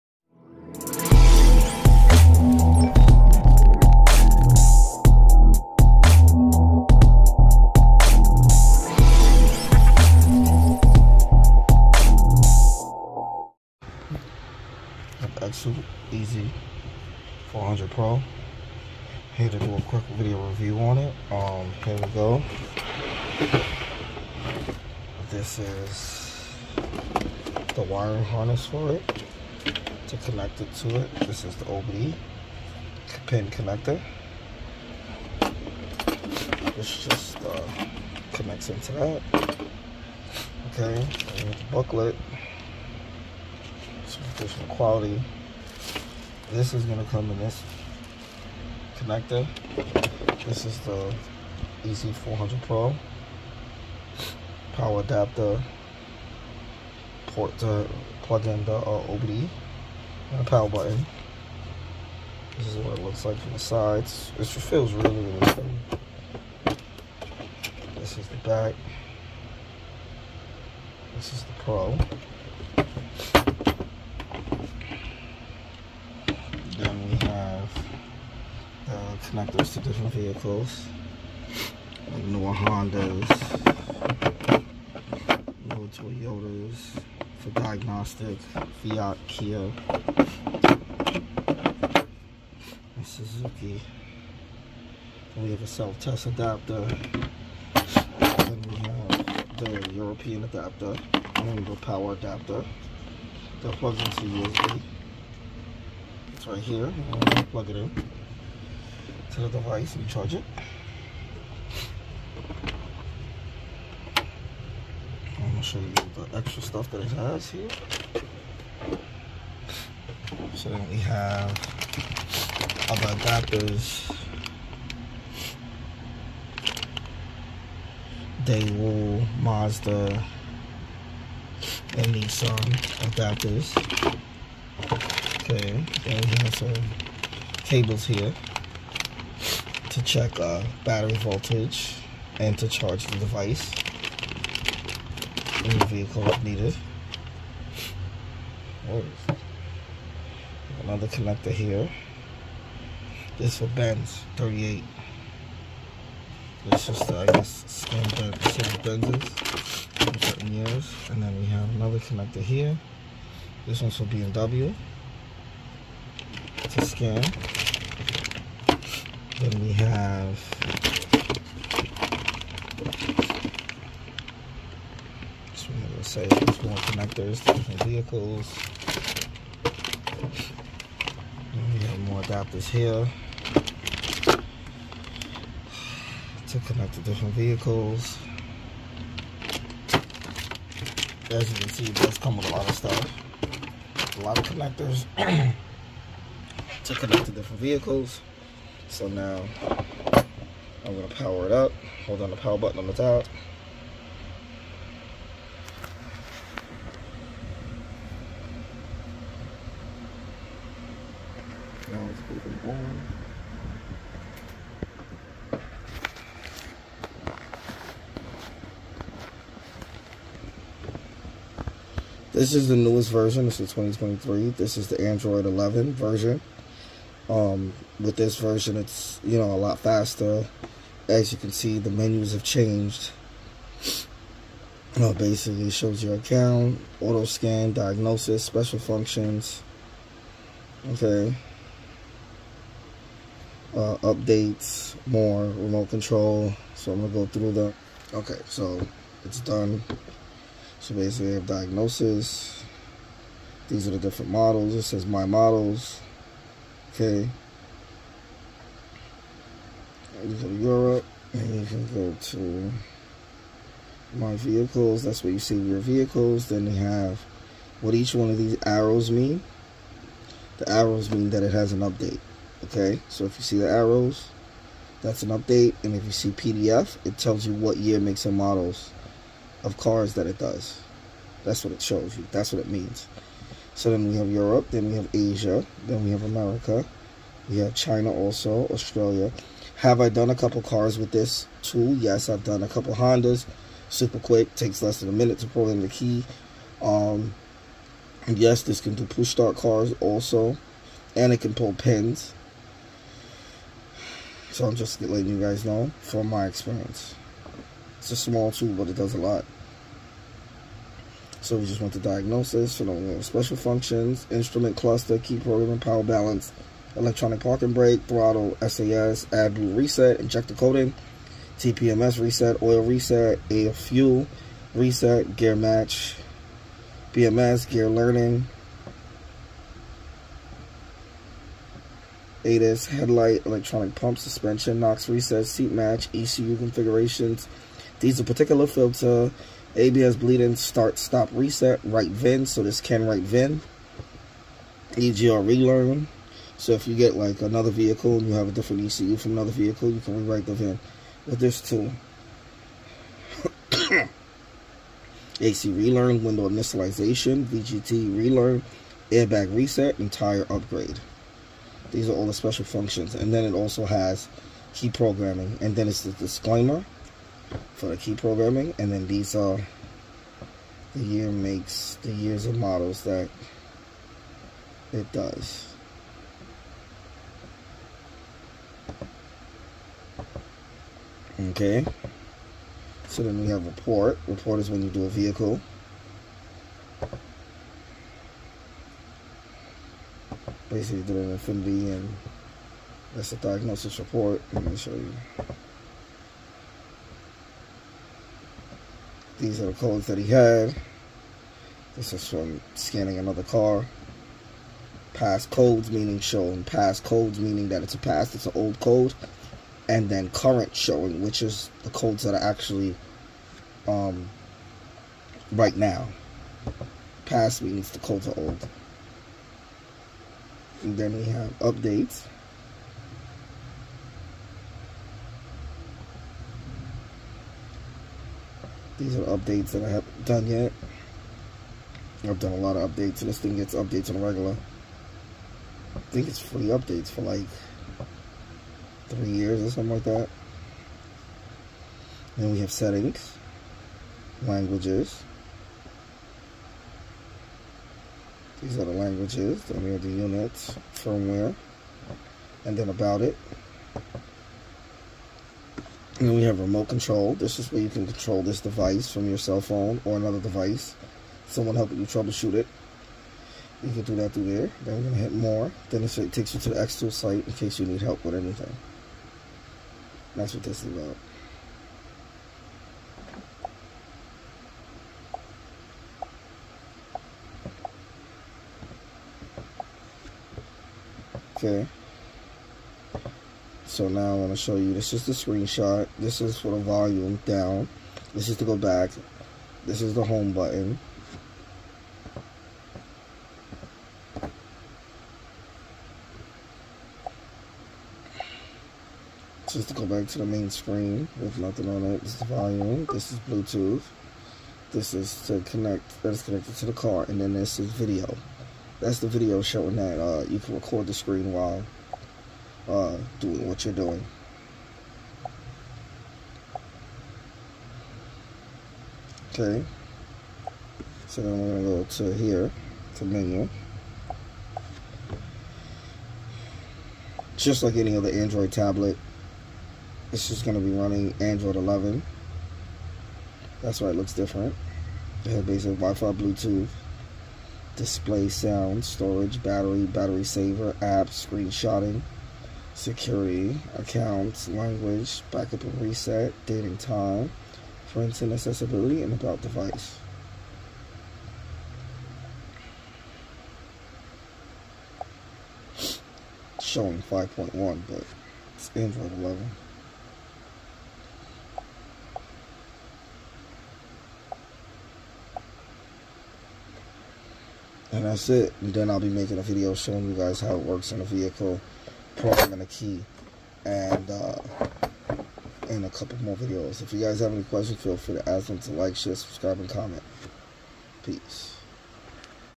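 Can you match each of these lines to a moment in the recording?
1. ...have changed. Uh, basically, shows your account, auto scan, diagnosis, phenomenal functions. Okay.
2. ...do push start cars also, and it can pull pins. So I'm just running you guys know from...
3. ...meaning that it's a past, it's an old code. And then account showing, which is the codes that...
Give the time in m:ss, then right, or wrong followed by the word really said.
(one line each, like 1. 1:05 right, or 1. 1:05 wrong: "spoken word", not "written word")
1. 3:52 wrong: "special", not "phenomenal"
2. 4:58 wrong: "letting", not "running"
3. 6:47 wrong: "current", not "account".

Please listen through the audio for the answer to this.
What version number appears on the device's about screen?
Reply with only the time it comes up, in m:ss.
9:17.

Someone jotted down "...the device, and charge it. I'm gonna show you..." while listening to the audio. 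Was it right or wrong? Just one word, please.
right.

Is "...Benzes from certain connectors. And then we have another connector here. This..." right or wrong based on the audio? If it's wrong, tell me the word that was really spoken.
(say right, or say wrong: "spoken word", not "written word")
wrong: "years", not "connectors".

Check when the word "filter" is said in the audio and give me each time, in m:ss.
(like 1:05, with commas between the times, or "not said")
5:38.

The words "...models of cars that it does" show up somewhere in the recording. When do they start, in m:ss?
4:38.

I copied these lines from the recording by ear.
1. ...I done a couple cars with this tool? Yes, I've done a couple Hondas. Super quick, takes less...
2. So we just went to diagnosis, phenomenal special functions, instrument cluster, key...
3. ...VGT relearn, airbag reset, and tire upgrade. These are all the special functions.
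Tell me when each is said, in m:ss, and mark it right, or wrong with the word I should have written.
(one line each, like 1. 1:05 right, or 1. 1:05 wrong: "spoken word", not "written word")
1. 4:50 right
2. 5:11 right
3. 5:57 right.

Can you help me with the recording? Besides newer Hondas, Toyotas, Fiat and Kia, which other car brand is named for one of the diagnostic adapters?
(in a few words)
Suzuki.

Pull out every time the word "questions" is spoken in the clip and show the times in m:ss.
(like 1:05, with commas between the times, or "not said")
9:37.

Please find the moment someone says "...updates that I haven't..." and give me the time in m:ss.
7:09.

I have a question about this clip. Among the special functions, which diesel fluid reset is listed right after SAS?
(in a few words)
AdBlue reset.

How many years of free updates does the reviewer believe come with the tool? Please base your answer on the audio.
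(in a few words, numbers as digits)
3.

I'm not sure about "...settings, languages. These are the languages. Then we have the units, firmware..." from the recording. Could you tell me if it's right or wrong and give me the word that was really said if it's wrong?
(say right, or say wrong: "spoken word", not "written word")
right.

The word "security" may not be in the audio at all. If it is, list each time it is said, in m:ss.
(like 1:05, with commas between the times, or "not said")
9:02.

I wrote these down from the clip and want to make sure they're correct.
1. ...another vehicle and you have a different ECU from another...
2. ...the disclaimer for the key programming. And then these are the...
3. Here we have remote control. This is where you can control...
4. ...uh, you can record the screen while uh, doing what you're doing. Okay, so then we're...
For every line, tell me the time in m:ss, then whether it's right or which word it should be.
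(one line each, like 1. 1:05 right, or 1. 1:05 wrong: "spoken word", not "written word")
1. 5:47 right
2. 6:06 right
3. 7:36 right
4. 8:30 right.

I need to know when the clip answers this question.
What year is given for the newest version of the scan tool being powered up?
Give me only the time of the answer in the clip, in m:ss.
3:43.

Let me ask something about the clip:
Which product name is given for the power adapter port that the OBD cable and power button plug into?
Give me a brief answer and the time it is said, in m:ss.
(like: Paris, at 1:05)
EZ400 Pro, at 0:51.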